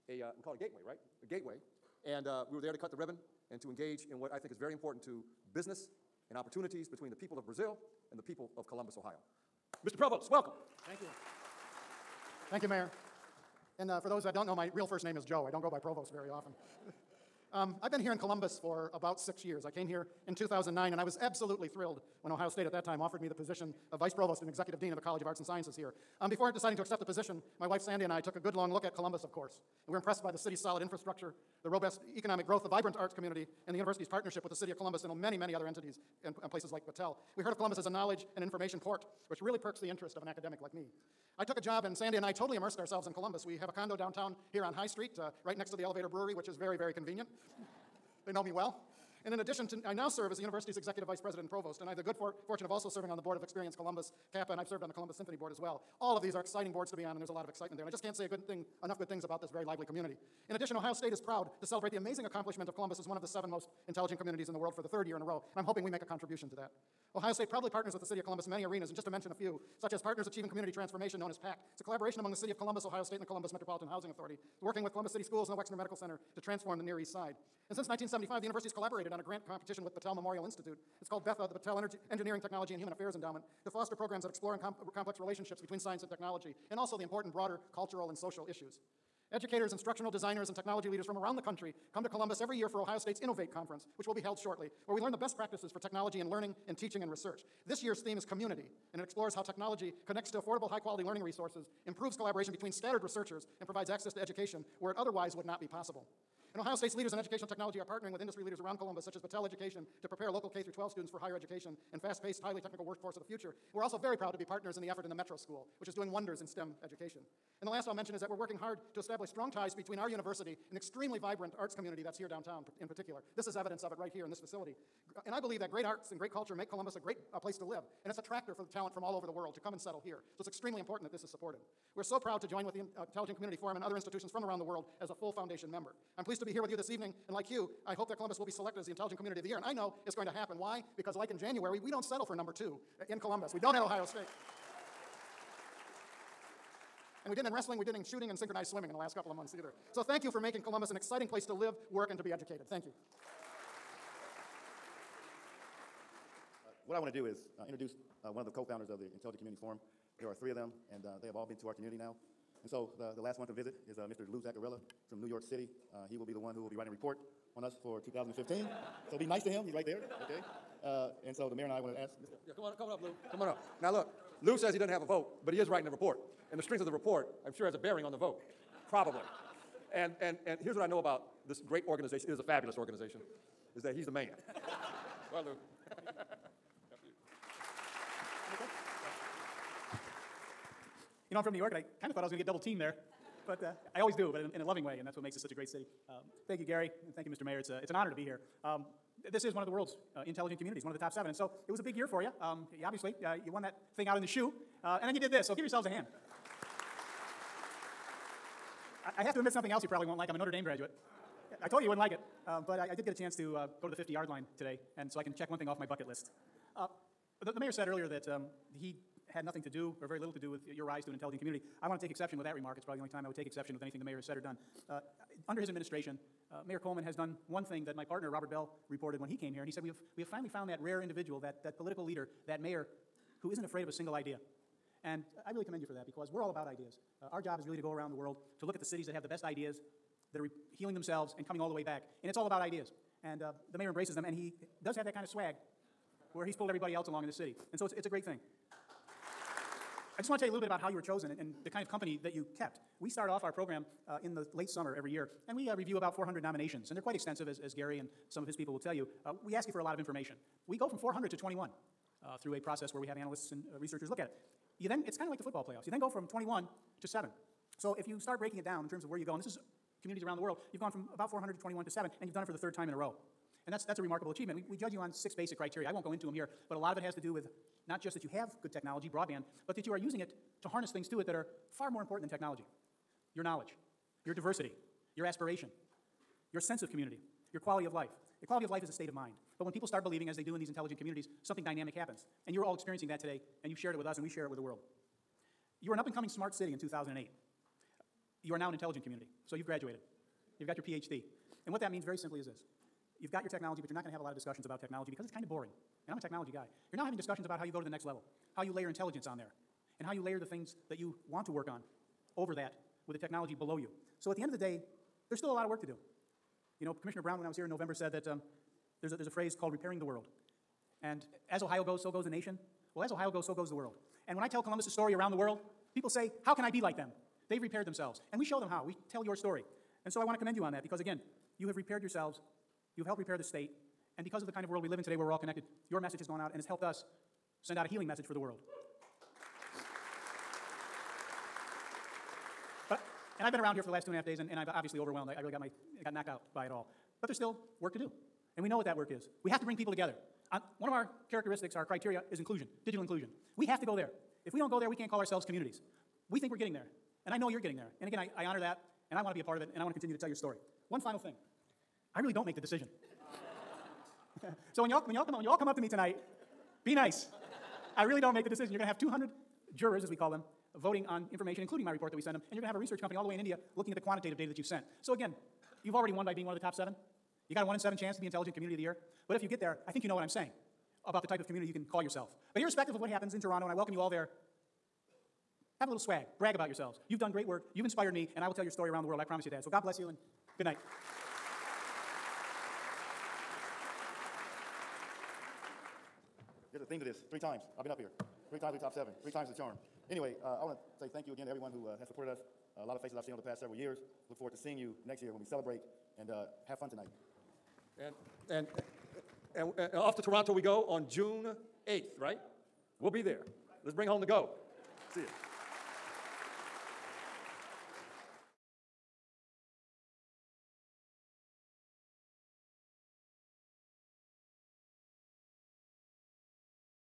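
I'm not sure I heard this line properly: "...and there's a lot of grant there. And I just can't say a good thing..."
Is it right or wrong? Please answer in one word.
wrong.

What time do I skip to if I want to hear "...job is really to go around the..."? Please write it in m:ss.
3:57.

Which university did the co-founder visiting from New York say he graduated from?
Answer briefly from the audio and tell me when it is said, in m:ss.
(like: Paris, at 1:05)
Notre Dame, at 3:30.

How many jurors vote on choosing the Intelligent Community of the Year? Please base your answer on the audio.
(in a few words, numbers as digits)
200.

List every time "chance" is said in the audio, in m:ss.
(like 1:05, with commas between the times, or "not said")
3:33, 6:17.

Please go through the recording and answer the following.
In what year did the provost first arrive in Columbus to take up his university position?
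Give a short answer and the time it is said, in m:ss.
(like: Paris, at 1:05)
2009, at 0:20.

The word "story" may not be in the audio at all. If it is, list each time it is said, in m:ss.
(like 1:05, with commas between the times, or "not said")
5:24, 5:29, 6:00, 6:28.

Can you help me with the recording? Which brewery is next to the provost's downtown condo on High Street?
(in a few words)
Elevator Brewery.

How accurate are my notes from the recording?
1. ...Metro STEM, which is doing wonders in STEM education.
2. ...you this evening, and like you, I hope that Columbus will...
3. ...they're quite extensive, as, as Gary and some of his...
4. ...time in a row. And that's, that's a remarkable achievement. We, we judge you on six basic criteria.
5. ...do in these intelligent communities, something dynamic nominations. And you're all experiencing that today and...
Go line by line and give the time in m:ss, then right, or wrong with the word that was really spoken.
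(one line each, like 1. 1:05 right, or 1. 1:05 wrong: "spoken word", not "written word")
1. 1:55 wrong: "School", not "STEM"
2. 2:16 right
3. 4:16 right
4. 4:32 right
5. 4:50 wrong: "happens", not "nominations".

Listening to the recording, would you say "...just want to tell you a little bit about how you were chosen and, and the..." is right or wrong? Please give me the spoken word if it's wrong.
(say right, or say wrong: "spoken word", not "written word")
right.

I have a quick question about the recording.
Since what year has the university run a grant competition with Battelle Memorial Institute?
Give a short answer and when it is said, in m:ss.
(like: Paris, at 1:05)
1975, at 1:17.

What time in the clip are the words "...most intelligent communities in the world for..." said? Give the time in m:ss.
1:03.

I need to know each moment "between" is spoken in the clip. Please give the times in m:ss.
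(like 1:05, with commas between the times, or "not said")
0:06, 1:25, 1:42, 1:59.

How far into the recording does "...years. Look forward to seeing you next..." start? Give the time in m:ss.
6:43.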